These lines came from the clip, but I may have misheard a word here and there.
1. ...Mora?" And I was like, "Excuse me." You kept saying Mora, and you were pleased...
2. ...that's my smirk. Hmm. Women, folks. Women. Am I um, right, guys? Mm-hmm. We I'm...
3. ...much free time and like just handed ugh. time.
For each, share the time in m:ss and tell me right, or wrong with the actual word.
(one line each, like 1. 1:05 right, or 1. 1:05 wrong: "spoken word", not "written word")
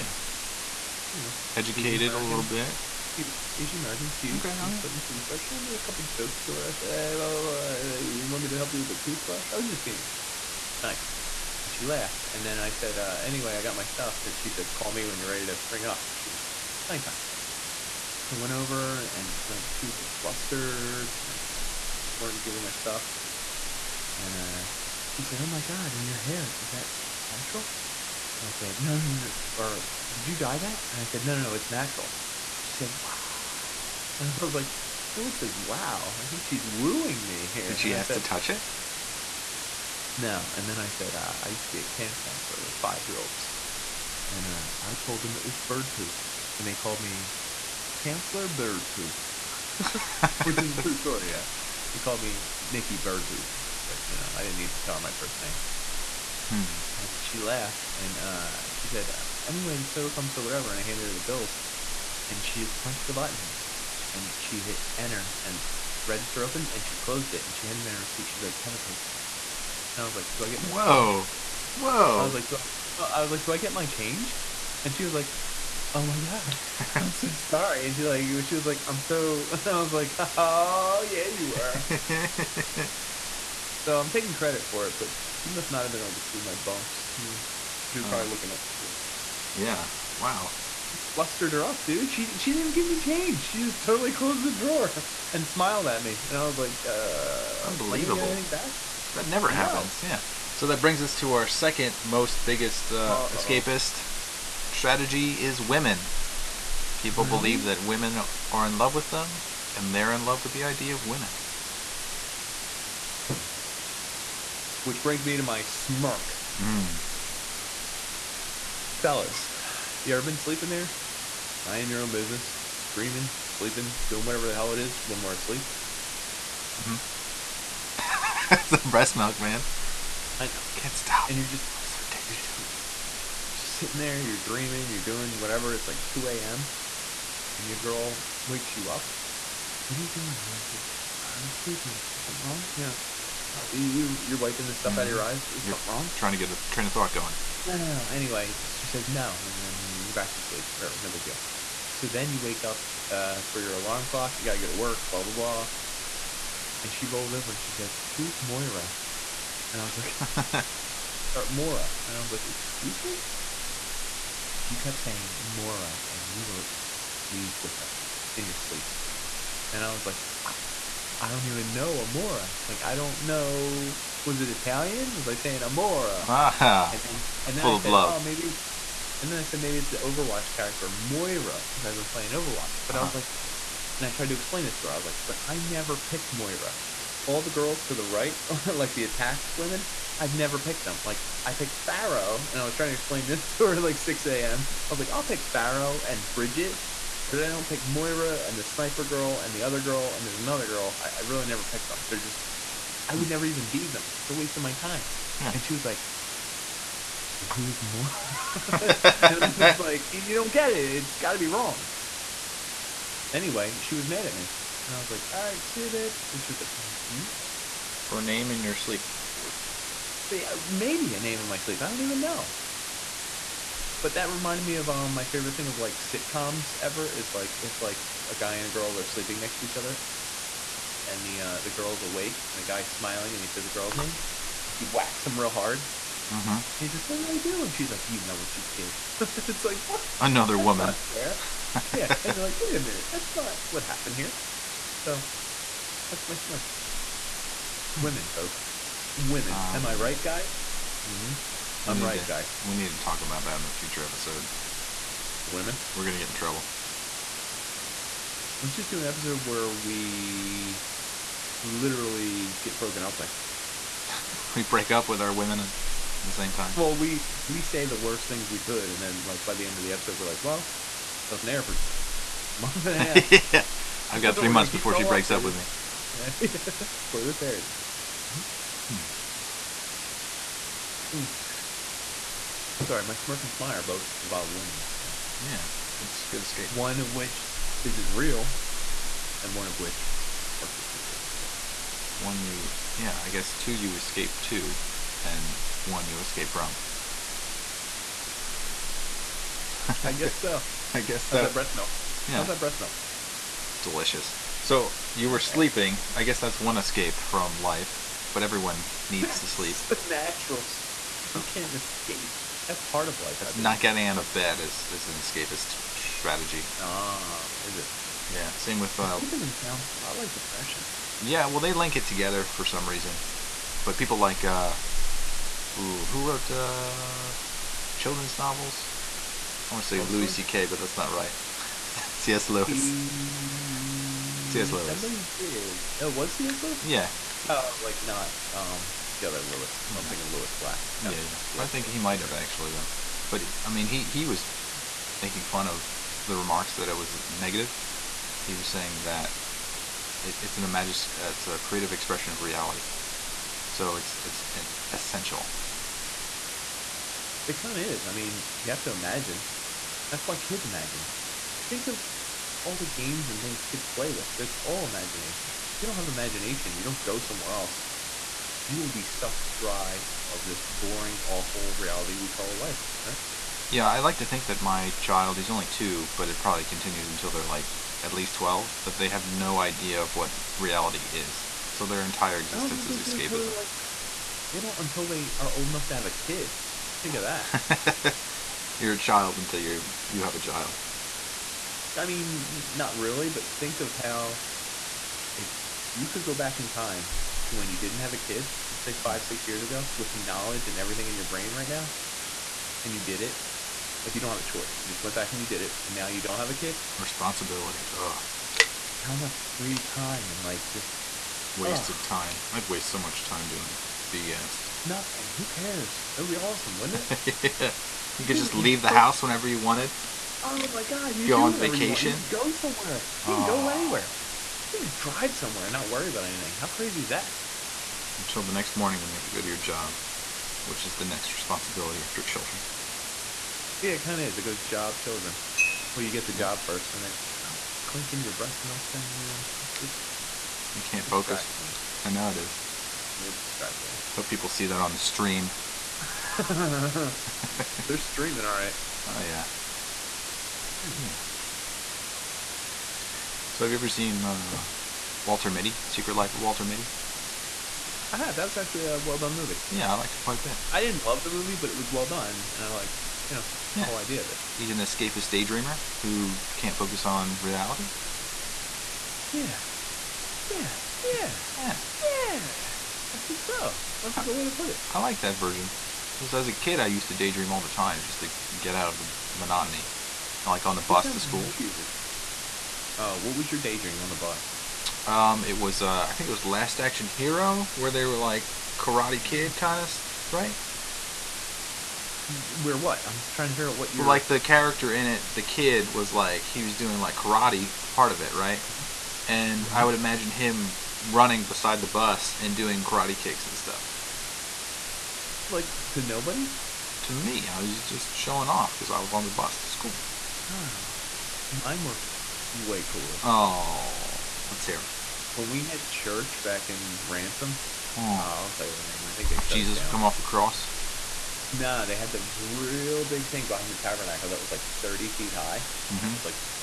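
1. 2:41 right
2. 4:06 right
3. 6:49 wrong: "wasted", not "handed".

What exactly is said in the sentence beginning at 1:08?
She's like, Have a great day.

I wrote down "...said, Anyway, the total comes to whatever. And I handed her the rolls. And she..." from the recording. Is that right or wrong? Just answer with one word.
wrong.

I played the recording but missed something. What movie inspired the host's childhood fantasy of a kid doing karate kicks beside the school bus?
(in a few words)
Last Action Hero.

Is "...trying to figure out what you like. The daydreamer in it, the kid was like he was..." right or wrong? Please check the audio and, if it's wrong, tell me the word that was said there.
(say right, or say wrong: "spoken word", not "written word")
wrong: "character", not "daydreamer".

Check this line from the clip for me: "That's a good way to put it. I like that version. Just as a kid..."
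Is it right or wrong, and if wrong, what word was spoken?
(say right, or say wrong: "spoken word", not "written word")
right.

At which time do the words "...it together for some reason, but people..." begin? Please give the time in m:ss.
5:21.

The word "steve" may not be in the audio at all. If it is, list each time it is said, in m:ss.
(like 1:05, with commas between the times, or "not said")
not said.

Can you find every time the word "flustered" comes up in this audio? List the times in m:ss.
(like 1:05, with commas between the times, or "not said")
0:20, 1:31.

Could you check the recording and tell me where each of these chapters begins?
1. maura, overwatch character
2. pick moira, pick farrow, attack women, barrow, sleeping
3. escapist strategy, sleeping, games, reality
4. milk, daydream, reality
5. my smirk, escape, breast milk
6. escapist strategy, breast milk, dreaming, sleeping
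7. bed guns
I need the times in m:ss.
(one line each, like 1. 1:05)
1. 2:04
2. 3:04
3. 5:04
4. 7:04
5. 4:04
6. 1:04
7. 8:04.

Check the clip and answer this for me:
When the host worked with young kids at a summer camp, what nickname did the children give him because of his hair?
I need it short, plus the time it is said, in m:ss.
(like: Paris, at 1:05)
Counselor Bird Poop, at 0:48.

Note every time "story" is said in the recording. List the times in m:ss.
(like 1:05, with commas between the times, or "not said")
0:50.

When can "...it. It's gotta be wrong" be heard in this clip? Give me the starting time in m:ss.
3:30.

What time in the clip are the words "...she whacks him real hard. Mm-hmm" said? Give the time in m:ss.
3:54.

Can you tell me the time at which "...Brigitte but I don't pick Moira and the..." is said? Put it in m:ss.
3:16.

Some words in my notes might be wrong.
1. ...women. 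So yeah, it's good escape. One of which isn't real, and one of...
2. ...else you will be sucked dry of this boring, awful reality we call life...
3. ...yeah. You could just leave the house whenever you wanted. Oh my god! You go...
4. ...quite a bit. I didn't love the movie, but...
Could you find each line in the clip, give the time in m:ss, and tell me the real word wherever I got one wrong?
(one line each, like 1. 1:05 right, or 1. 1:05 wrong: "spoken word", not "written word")
1. 4:44 right
2. 6:07 right
3. 6:57 right
4. 7:40 right.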